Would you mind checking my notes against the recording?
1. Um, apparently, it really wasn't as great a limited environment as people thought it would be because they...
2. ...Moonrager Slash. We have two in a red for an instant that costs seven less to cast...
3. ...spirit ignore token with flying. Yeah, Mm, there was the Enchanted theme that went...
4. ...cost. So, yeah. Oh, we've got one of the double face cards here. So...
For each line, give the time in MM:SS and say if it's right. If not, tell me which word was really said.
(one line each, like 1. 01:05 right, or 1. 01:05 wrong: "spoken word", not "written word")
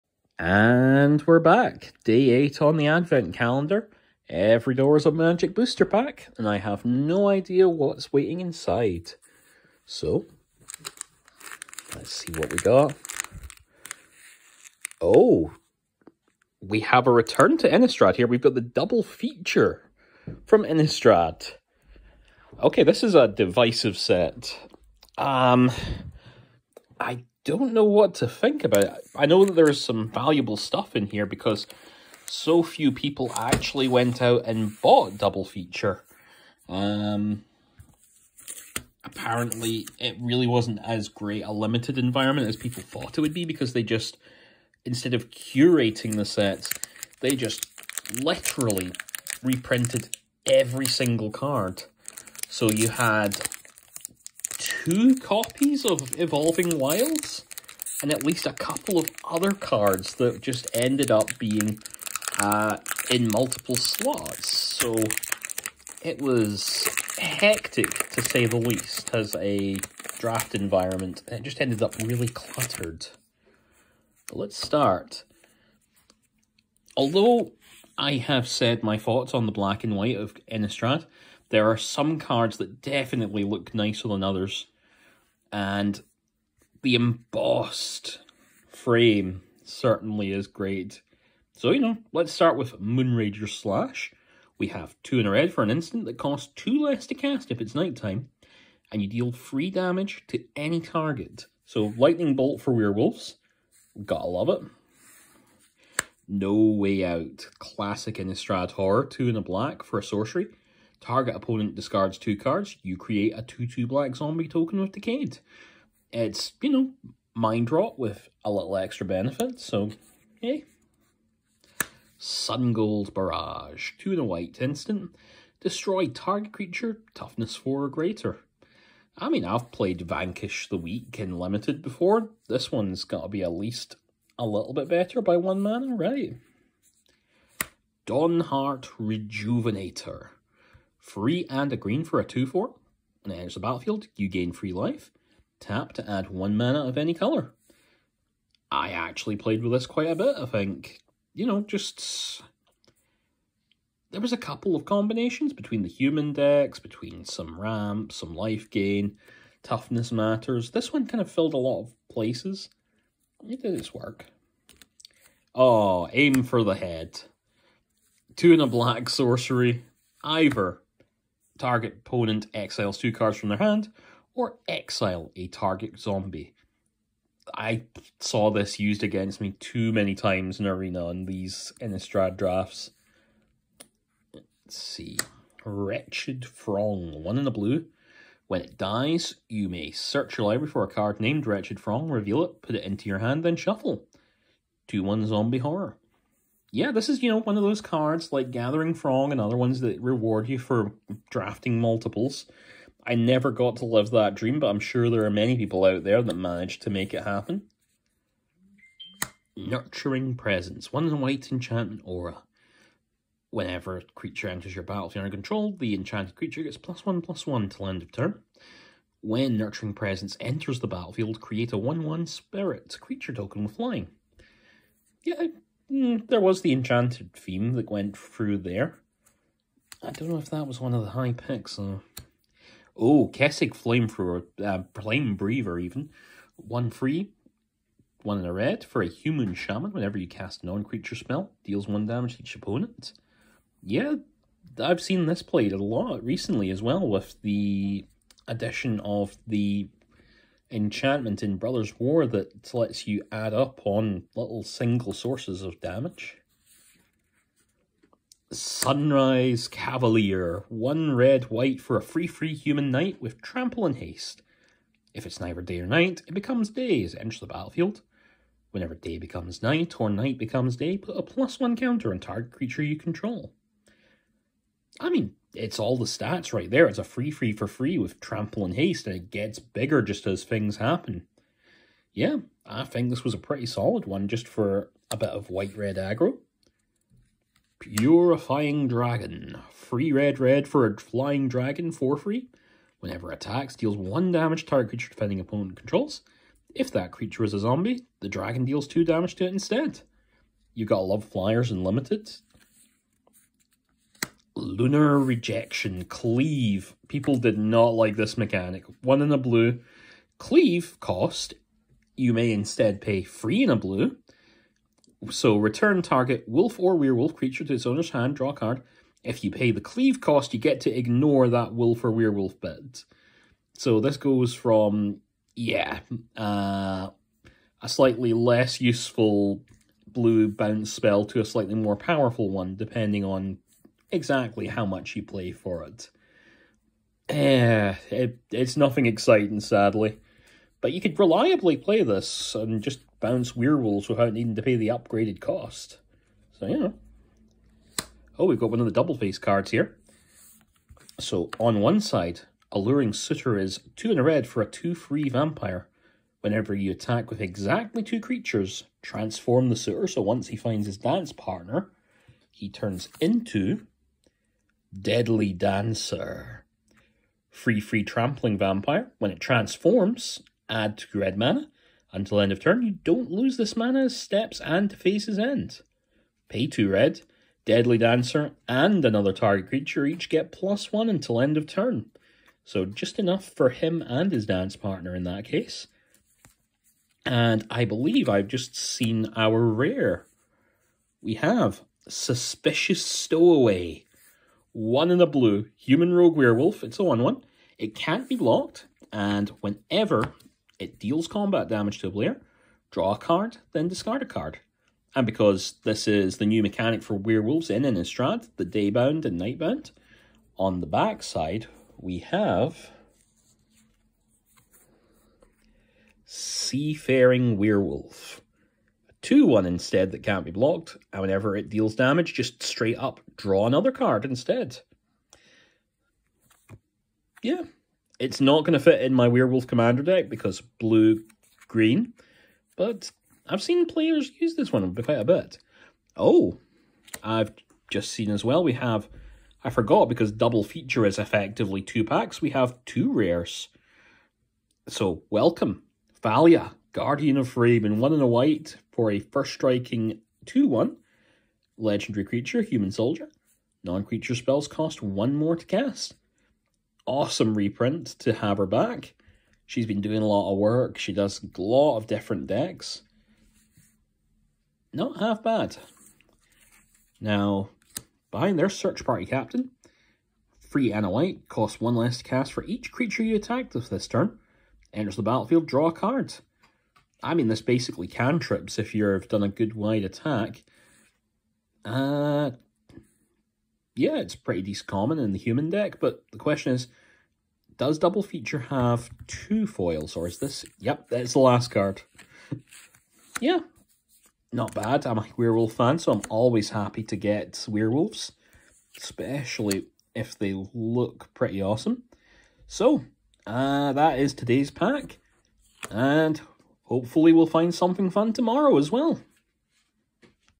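1. 00:36 right
2. 01:32 wrong: "two", not "seven"
3. 03:42 wrong: "creature", not "ignore"
4. 05:45 right.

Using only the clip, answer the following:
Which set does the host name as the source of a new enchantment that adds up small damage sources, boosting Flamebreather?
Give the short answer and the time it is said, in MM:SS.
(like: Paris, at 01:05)
Brothers War, at 04:11.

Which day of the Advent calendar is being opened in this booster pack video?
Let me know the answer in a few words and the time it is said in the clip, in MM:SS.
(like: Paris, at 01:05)
8, at 00:02.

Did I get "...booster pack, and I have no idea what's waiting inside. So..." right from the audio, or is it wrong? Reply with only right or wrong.
right.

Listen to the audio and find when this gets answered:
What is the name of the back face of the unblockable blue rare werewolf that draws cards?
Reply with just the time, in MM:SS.
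06:56.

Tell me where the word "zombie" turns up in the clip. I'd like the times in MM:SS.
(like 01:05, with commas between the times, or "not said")
01:54, 02:55, 03:15, 04:57.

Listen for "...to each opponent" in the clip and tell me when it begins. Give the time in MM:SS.
04:02.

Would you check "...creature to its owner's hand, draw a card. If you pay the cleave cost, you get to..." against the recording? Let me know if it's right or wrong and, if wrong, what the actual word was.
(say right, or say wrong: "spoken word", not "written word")
right.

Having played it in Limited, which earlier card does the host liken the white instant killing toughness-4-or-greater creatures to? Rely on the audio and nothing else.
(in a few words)
Vanquish the Weak.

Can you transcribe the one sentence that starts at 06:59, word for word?
2 1 instead that can't be blocked, and whenever it deals damage, just straight up draw another card instead.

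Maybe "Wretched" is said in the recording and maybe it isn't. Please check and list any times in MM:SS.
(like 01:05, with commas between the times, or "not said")
03:05, 03:11.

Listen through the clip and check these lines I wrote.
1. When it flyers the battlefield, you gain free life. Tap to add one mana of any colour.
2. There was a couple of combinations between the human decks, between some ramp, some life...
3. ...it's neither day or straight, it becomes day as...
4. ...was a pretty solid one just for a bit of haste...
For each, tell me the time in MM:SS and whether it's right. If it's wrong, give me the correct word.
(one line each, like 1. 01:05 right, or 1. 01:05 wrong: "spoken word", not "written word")
1. 02:23 wrong: "enters", not "flyers"
2. 02:34 right
3. 04:25 wrong: "night", not "straight"
4. 04:43 wrong: "white", not "haste".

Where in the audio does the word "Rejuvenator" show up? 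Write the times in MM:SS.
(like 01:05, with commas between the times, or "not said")
02:18.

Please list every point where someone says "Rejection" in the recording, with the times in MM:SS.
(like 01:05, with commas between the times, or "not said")
05:05.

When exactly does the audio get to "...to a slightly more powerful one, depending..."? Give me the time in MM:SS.
05:31.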